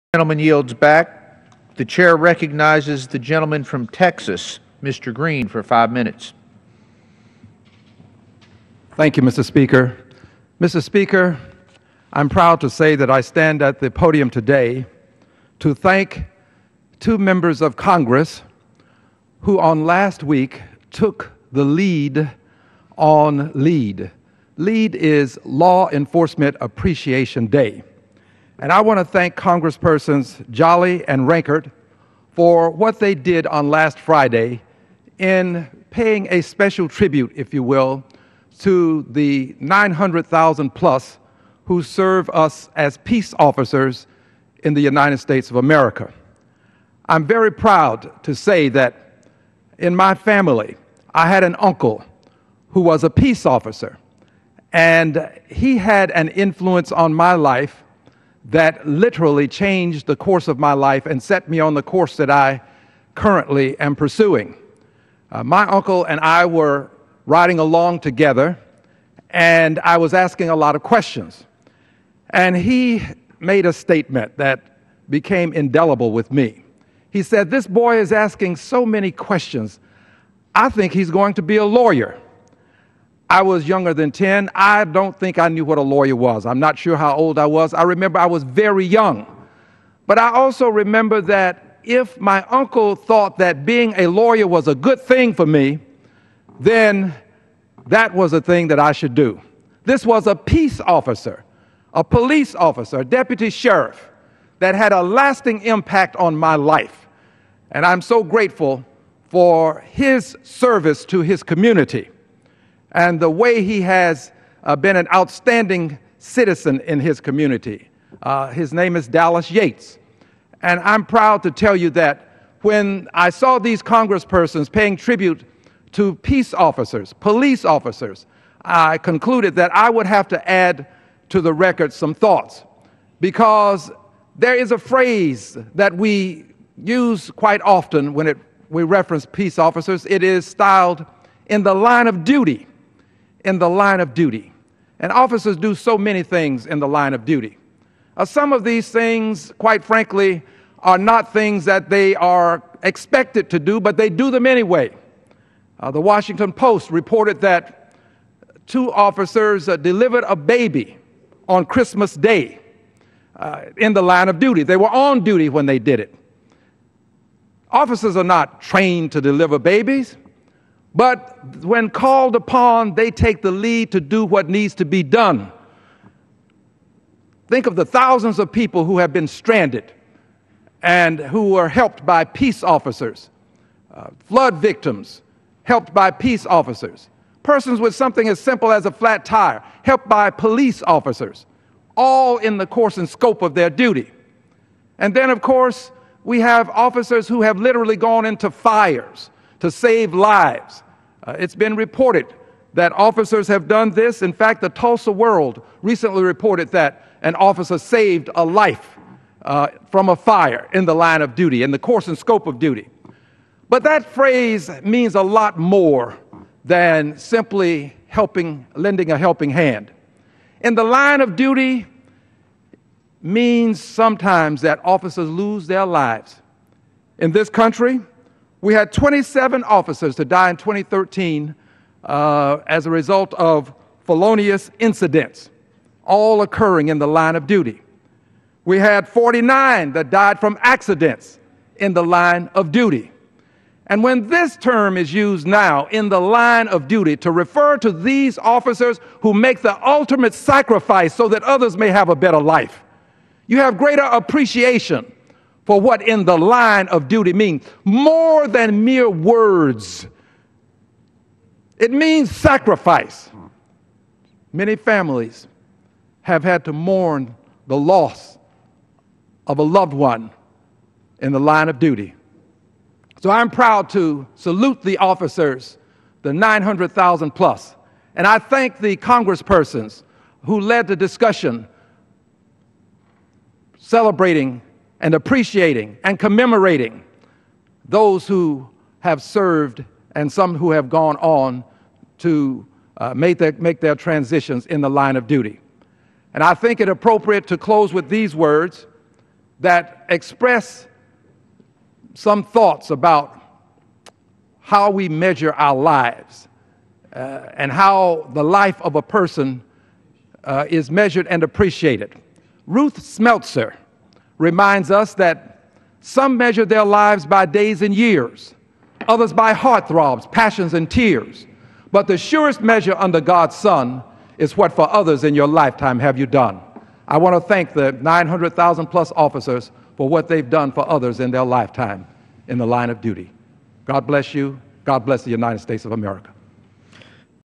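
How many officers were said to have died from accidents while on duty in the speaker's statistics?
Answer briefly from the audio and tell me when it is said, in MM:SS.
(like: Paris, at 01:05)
49, at 03:59.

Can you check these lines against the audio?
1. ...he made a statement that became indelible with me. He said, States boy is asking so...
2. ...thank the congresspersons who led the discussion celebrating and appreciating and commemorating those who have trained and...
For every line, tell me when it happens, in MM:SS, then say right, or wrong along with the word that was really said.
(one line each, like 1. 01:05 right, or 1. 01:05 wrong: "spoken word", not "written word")
1. 01:12 wrong: "This", not "States"
2. 04:38 wrong: "served", not "trained".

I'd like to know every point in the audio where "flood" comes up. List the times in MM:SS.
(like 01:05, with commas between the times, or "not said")
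03:04.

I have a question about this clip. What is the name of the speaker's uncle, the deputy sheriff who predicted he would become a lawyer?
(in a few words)
Dallas Yates.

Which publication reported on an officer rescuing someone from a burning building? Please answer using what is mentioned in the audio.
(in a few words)
Tulsa World.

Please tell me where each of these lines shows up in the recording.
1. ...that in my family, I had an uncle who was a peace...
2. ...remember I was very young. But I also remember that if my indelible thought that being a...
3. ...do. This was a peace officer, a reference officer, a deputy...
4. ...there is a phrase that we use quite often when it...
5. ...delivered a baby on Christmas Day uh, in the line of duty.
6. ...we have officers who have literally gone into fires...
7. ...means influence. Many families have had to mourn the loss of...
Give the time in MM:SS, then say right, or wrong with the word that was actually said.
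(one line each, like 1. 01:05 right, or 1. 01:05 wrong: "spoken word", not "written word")
1. 00:48 right
2. 01:27 wrong: "uncle", not "indelible"
3. 01:39 wrong: "police", not "reference"
4. 02:14 right
5. 02:39 right
6. 03:16 right
7. 04:21 wrong: "sacrifice", not "influence".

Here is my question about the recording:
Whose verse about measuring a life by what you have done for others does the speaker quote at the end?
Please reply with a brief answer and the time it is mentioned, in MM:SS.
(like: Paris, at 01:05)
Ruth Smeltzer, at 05:12.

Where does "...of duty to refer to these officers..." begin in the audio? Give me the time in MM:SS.
04:06.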